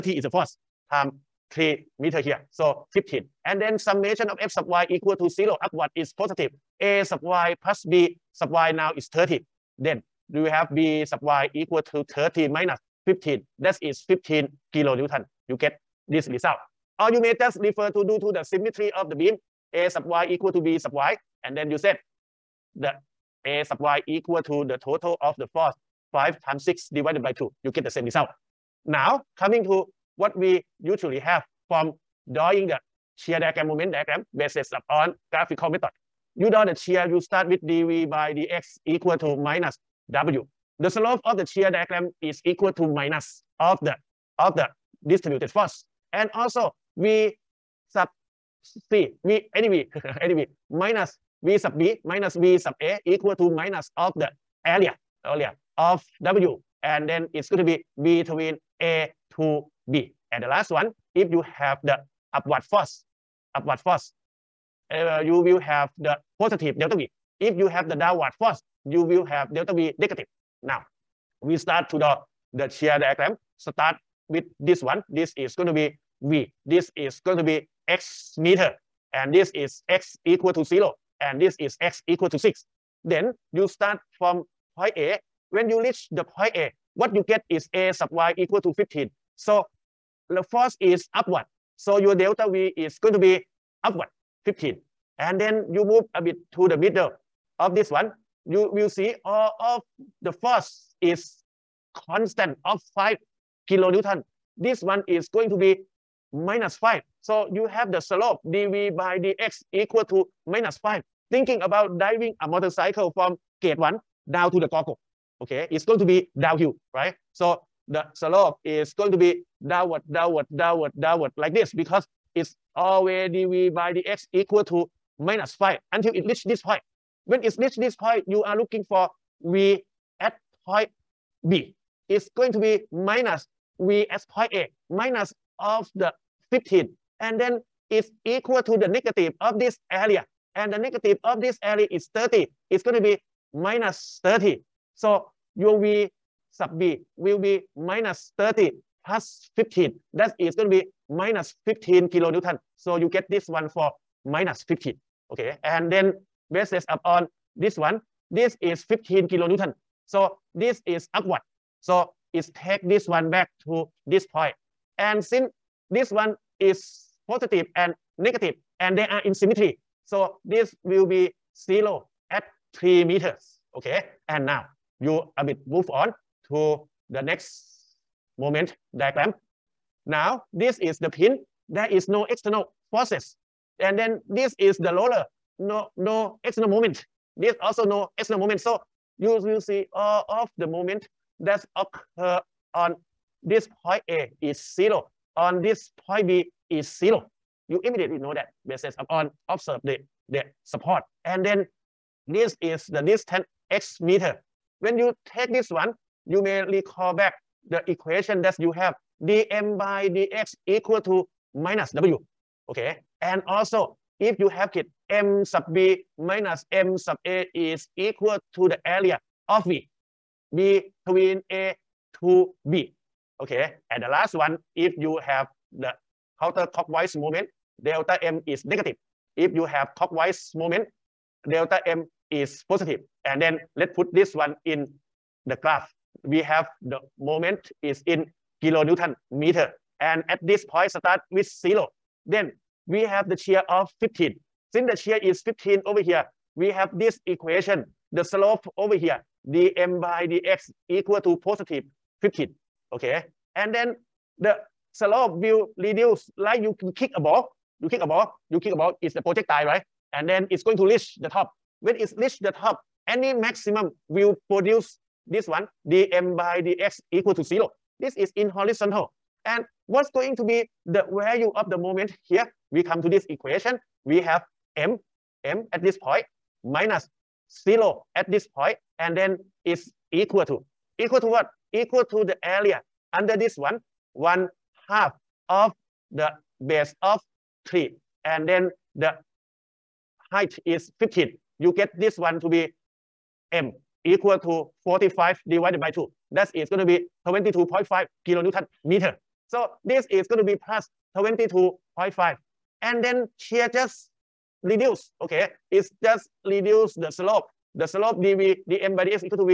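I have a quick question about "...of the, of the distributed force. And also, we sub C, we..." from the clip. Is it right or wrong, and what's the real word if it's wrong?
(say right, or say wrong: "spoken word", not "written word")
right.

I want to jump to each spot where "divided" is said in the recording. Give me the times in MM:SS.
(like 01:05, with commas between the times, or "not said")
00:26, 04:55.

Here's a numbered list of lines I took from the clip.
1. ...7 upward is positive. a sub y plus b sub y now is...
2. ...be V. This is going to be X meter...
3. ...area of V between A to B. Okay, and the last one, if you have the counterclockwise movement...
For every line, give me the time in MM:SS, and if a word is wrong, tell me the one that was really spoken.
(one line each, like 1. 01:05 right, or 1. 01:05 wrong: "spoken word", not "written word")
1. 00:05 wrong: "0", not "7"
2. 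01:15 right
3. 03:38 right.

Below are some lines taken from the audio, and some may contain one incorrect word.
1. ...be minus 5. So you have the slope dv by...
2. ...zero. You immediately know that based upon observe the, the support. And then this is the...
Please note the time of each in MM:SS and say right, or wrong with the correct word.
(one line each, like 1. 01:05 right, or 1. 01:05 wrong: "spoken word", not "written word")
1. 01:45 right
2. 03:16 right.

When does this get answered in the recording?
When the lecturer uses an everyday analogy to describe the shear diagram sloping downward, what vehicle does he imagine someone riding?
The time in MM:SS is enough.
01:52.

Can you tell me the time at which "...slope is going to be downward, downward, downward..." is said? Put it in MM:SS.
01:58.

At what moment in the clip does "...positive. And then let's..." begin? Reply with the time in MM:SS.
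03:52.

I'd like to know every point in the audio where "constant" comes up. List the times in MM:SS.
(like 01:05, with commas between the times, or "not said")
01:42.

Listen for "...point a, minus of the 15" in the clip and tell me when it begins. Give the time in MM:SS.
02:14.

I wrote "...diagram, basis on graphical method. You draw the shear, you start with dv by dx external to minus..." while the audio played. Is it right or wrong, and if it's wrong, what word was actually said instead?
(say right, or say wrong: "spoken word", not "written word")
wrong: "equal", not "external".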